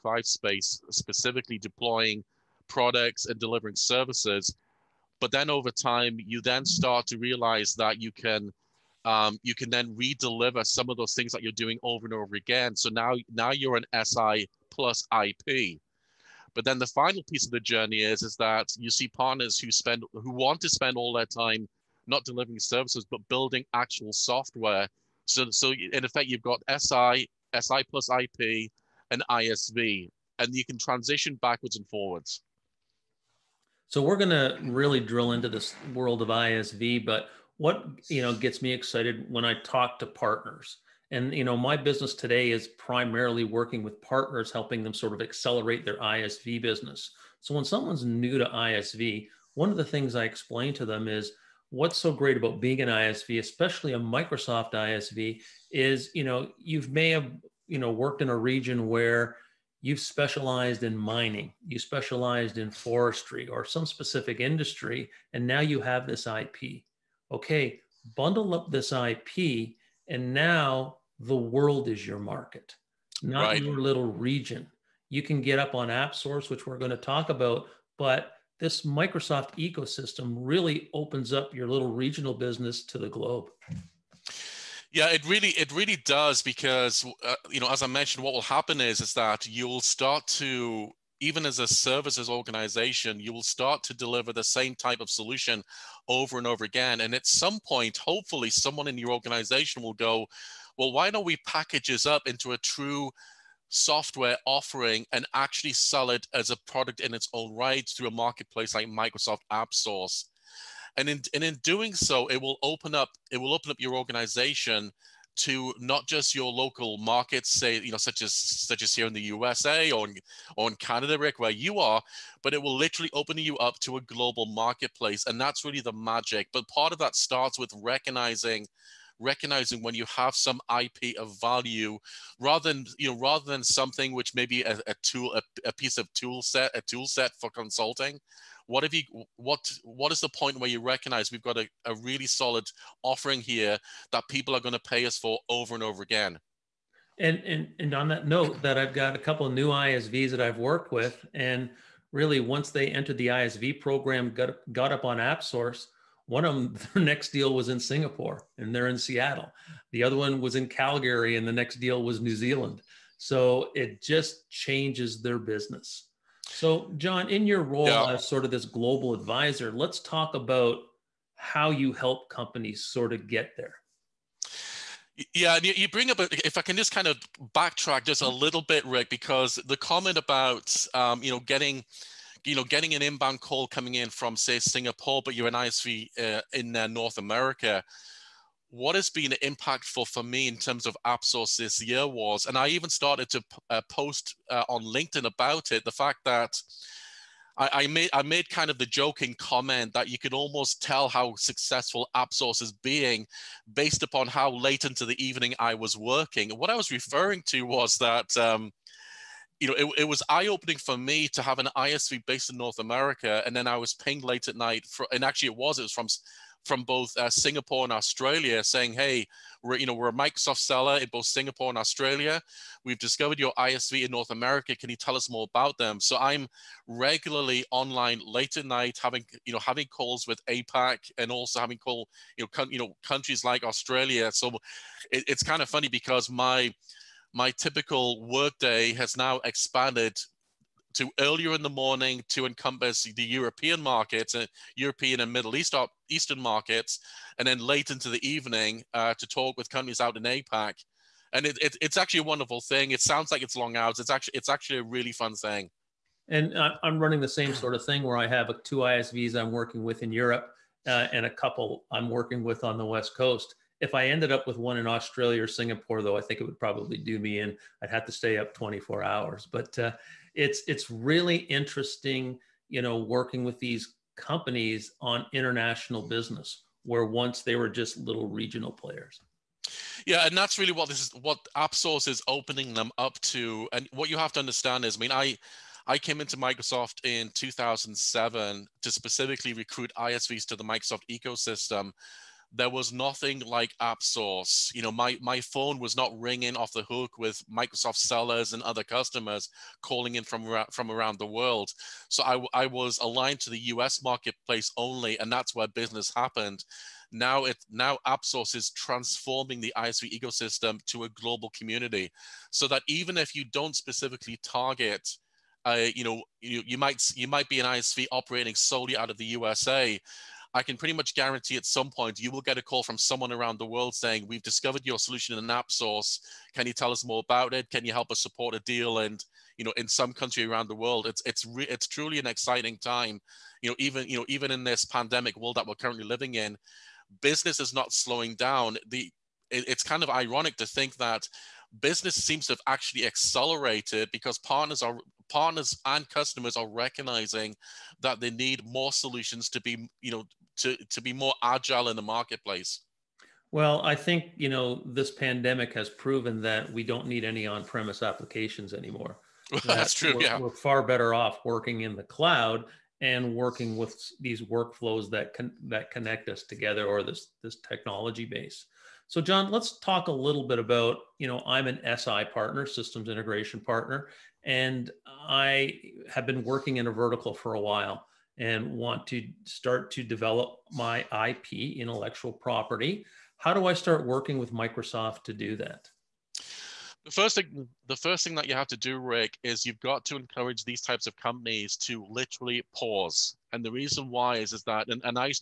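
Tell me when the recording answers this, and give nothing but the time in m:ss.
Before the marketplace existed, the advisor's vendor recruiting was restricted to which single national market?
5:03.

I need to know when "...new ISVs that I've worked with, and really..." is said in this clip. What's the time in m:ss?
2:29.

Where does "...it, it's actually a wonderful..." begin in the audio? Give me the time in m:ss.
4:11.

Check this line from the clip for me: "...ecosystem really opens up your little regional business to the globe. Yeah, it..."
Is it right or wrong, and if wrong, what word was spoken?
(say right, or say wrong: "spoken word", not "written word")
right.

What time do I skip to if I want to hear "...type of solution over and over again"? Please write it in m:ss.
1:34.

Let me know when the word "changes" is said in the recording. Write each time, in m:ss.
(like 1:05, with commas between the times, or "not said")
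2:44.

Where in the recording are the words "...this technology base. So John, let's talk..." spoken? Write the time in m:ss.
6:07.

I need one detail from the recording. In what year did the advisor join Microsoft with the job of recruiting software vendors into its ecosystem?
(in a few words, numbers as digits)
2007.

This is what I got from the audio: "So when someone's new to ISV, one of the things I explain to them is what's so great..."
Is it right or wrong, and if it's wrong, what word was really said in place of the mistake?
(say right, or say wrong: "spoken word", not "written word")
right.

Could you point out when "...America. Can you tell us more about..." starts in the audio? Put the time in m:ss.
3:44.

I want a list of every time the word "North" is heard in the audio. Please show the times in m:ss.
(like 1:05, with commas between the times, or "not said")
3:06, 3:32, 3:44.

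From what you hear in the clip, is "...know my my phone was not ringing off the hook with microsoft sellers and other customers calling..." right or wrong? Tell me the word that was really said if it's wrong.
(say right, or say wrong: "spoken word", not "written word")
right.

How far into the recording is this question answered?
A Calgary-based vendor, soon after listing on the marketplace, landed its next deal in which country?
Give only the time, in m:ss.
2:42.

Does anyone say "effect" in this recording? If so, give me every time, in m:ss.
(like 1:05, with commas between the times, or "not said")
0:26.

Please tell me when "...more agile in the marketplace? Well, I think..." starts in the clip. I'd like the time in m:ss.
5:51.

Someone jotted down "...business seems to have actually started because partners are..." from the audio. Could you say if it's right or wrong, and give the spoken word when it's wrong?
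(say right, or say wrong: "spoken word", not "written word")
wrong: "accelerated", not "started".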